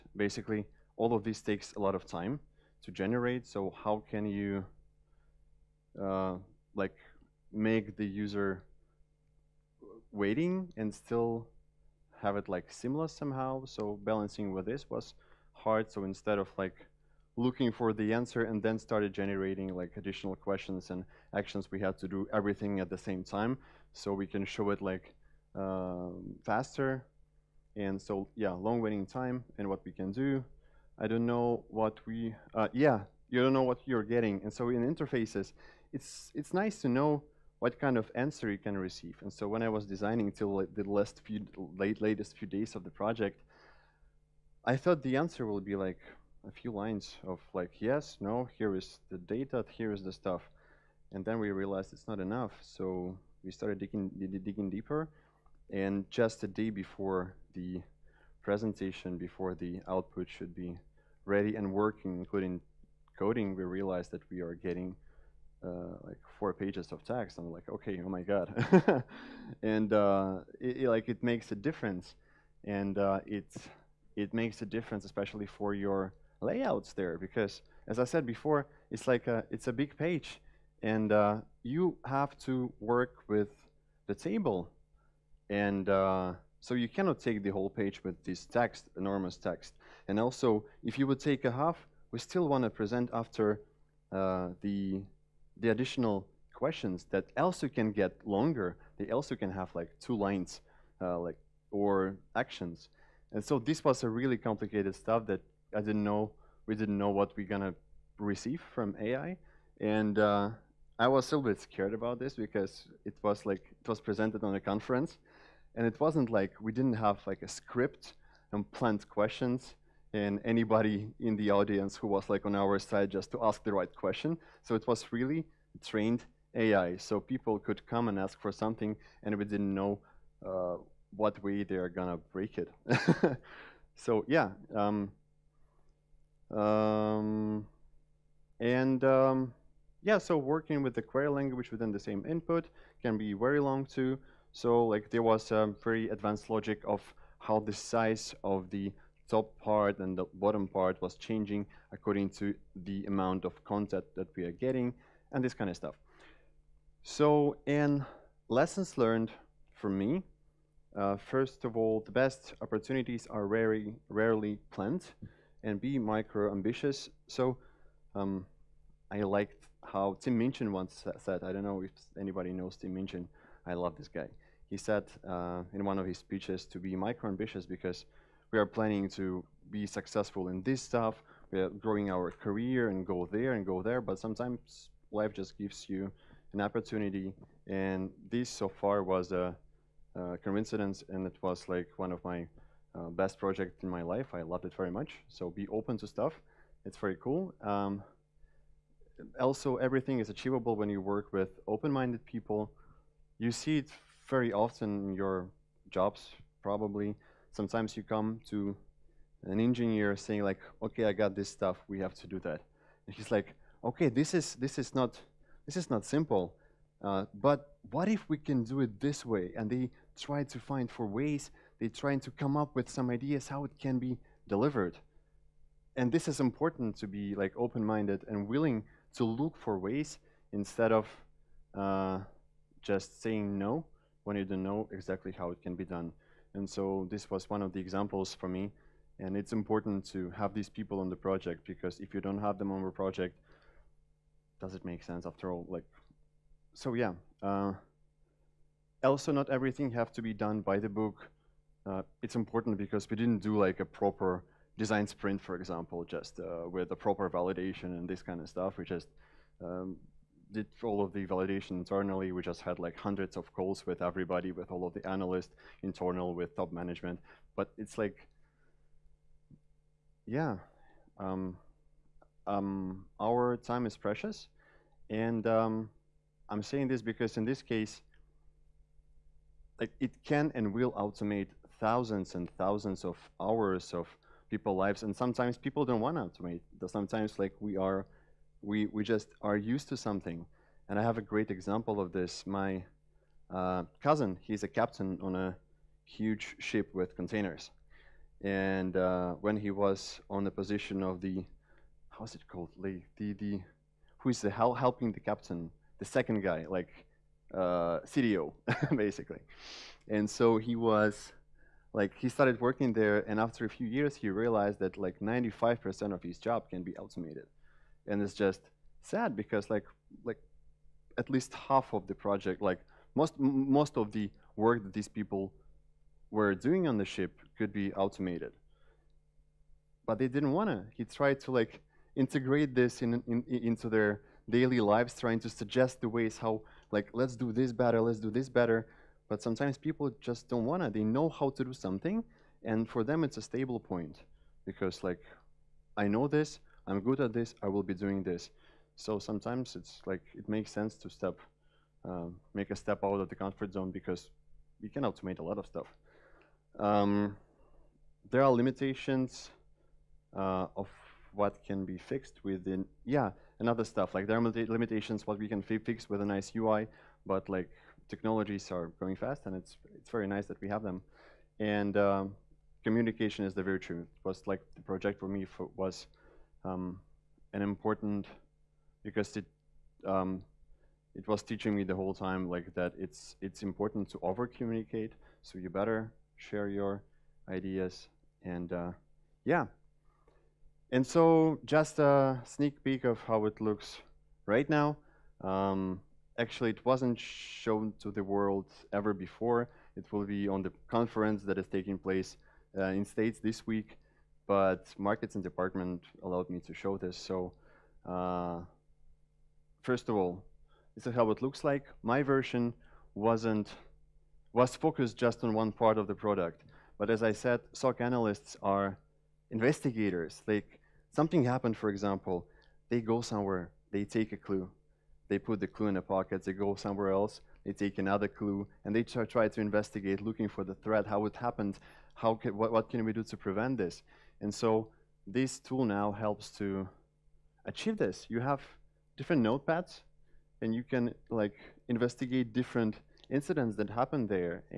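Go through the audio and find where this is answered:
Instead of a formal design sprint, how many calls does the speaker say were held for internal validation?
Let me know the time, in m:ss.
4:22.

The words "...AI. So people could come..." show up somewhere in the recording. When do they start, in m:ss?
2:06.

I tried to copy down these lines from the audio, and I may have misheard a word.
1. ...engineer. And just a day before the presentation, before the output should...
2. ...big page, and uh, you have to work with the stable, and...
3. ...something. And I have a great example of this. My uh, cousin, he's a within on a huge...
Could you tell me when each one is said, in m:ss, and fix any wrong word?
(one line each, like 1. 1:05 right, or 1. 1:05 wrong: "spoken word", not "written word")
1. 0:54 wrong: "deeper", not "engineer"
2. 1:19 wrong: "table", not "stable"
3. 4:49 wrong: "captain", not "within".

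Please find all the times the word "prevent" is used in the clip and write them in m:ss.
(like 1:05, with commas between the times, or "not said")
7:13.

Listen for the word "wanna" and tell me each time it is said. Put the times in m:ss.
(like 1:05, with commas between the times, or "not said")
5:30, 5:40.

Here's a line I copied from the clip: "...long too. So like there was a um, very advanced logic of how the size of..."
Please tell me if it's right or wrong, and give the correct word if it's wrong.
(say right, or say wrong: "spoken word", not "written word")
right.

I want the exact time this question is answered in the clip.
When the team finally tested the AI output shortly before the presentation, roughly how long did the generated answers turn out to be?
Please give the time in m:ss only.
1:06.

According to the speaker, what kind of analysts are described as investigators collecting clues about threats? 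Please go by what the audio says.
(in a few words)
SOC analysts.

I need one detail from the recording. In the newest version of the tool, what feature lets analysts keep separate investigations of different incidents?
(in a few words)
Notepads.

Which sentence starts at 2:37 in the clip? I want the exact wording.
So in lessons learned from me, uh, first of all, the best opportunities are very rarely planned and be micro-ambitious.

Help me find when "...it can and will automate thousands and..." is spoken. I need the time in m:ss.
4:39.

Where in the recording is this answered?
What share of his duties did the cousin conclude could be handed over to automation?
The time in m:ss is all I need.
5:15.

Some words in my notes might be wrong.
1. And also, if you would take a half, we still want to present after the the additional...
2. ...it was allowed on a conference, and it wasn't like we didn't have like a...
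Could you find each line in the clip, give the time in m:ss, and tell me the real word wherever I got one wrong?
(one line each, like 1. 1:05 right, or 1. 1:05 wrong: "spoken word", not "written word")
1. 1:30 right
2. 1:53 wrong: "presented", not "allowed".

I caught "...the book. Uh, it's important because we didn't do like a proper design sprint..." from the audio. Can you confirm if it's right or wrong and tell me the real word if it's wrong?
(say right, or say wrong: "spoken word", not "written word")
right.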